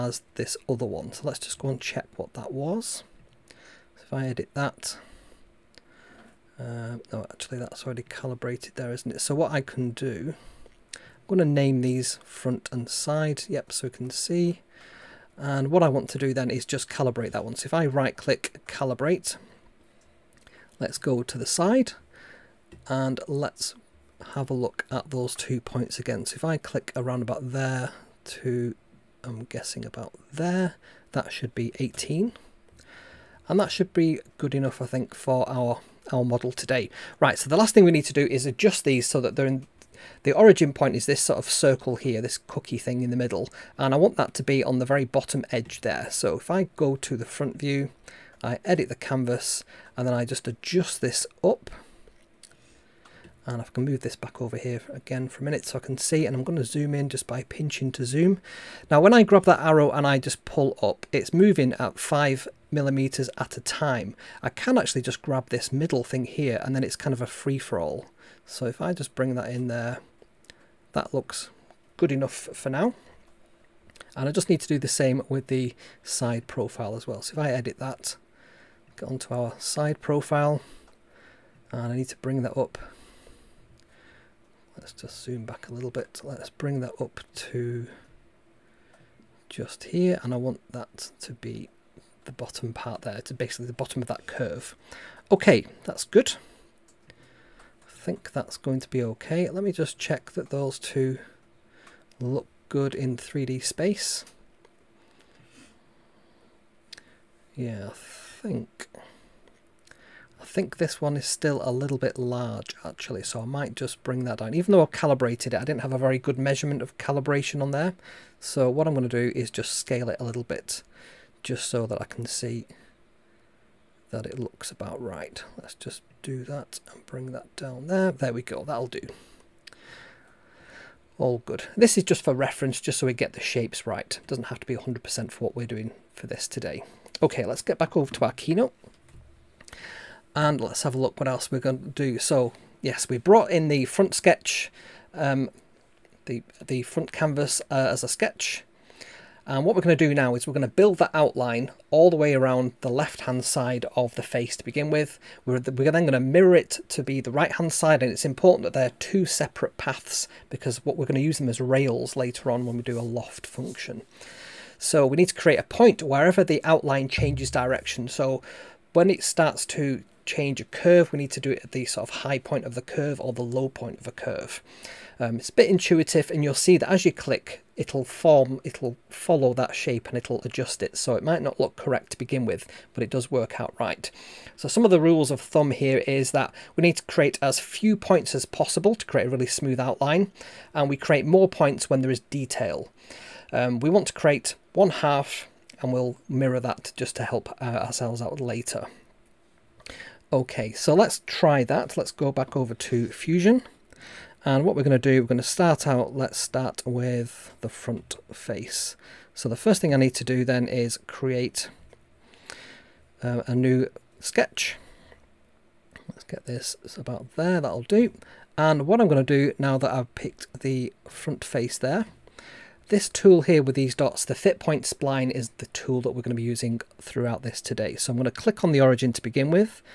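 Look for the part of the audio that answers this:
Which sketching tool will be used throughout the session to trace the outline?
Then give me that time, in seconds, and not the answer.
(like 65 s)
224 s.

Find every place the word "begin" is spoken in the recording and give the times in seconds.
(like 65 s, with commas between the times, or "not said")
154 s, 182 s, 229 s.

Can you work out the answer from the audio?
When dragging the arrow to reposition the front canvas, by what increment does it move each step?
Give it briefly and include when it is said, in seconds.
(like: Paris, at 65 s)
5 millimeters, at 61 s.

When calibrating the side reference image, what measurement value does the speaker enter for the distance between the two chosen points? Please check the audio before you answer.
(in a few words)
18.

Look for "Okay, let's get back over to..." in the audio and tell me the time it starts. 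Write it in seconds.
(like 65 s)
137 s.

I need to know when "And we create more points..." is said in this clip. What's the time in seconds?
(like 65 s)
190 s.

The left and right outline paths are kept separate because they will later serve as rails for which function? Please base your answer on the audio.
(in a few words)
loft.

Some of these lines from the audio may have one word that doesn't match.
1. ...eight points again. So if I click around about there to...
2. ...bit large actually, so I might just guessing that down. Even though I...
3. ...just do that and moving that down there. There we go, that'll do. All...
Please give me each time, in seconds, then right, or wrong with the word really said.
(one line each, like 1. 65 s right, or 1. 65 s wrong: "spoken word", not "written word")
1. 25 s wrong: "two", not "eight"
2. 111 s wrong: "bring", not "guessing"
3. 125 s wrong: "bring", not "moving".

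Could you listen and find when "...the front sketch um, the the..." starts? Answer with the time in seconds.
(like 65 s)
143 s.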